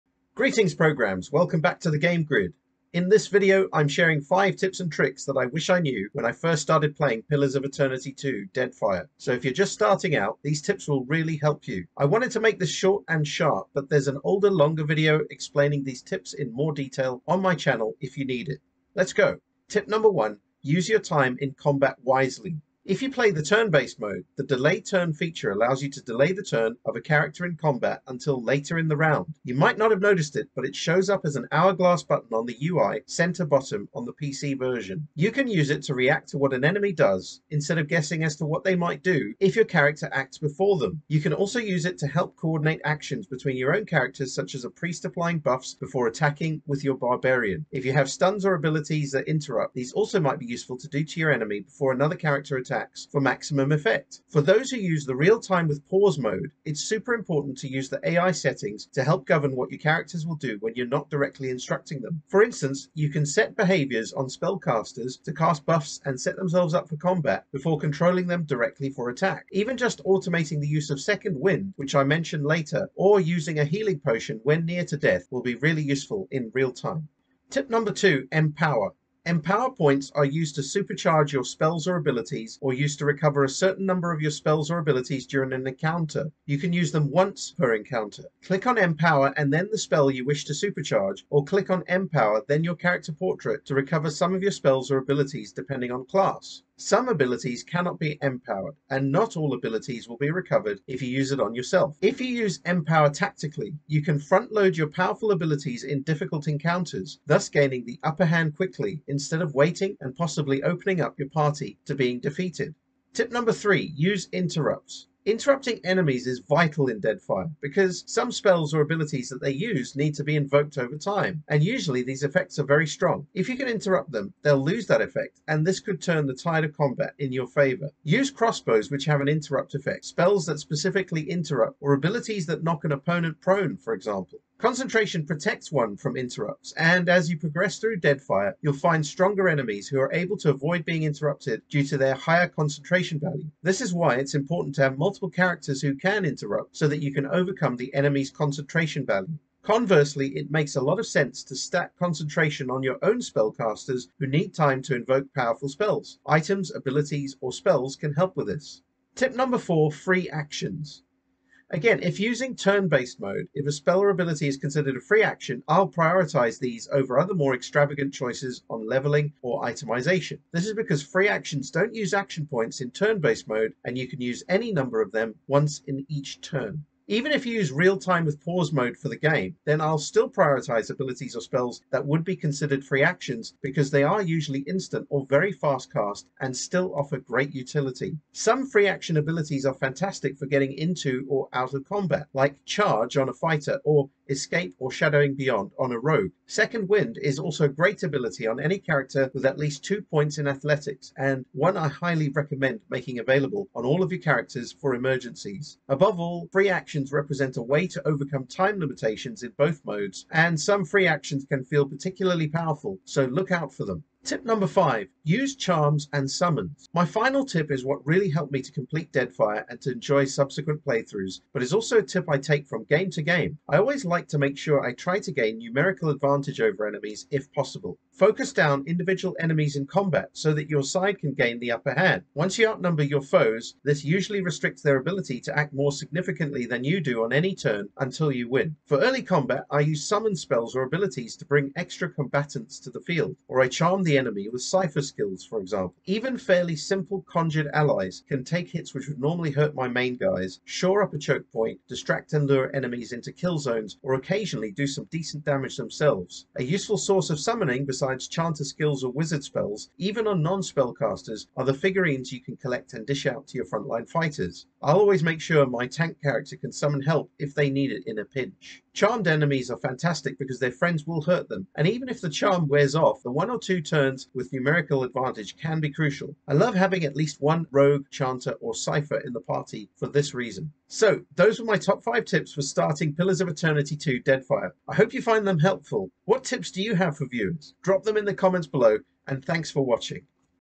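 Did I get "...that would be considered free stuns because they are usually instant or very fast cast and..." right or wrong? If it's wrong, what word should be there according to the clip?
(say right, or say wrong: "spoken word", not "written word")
wrong: "actions", not "stuns".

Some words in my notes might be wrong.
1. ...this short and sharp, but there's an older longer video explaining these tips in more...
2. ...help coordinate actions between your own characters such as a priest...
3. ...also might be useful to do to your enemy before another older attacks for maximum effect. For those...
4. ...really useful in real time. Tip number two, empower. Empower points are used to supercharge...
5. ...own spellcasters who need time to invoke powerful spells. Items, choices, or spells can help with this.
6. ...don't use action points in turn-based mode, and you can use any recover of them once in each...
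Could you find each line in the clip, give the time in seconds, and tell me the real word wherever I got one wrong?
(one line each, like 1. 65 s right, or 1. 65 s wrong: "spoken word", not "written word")
1. 12 s right
2. 42 s right
3. 49 s wrong: "character", not "older"
4. 75 s right
5. 153 s wrong: "abilities", not "choices"
6. 171 s wrong: "number", not "recover".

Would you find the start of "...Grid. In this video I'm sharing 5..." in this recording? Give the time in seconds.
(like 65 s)
2 s.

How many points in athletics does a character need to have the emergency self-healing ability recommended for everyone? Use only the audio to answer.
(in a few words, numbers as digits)
2.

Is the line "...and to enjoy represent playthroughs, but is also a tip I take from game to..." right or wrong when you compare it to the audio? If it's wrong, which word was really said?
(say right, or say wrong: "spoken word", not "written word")
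wrong: "subsequent", not "represent".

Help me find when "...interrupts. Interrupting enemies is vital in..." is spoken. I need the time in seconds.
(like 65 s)
114 s.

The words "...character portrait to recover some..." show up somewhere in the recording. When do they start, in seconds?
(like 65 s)
92 s.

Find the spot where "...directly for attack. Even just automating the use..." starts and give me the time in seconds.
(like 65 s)
68 s.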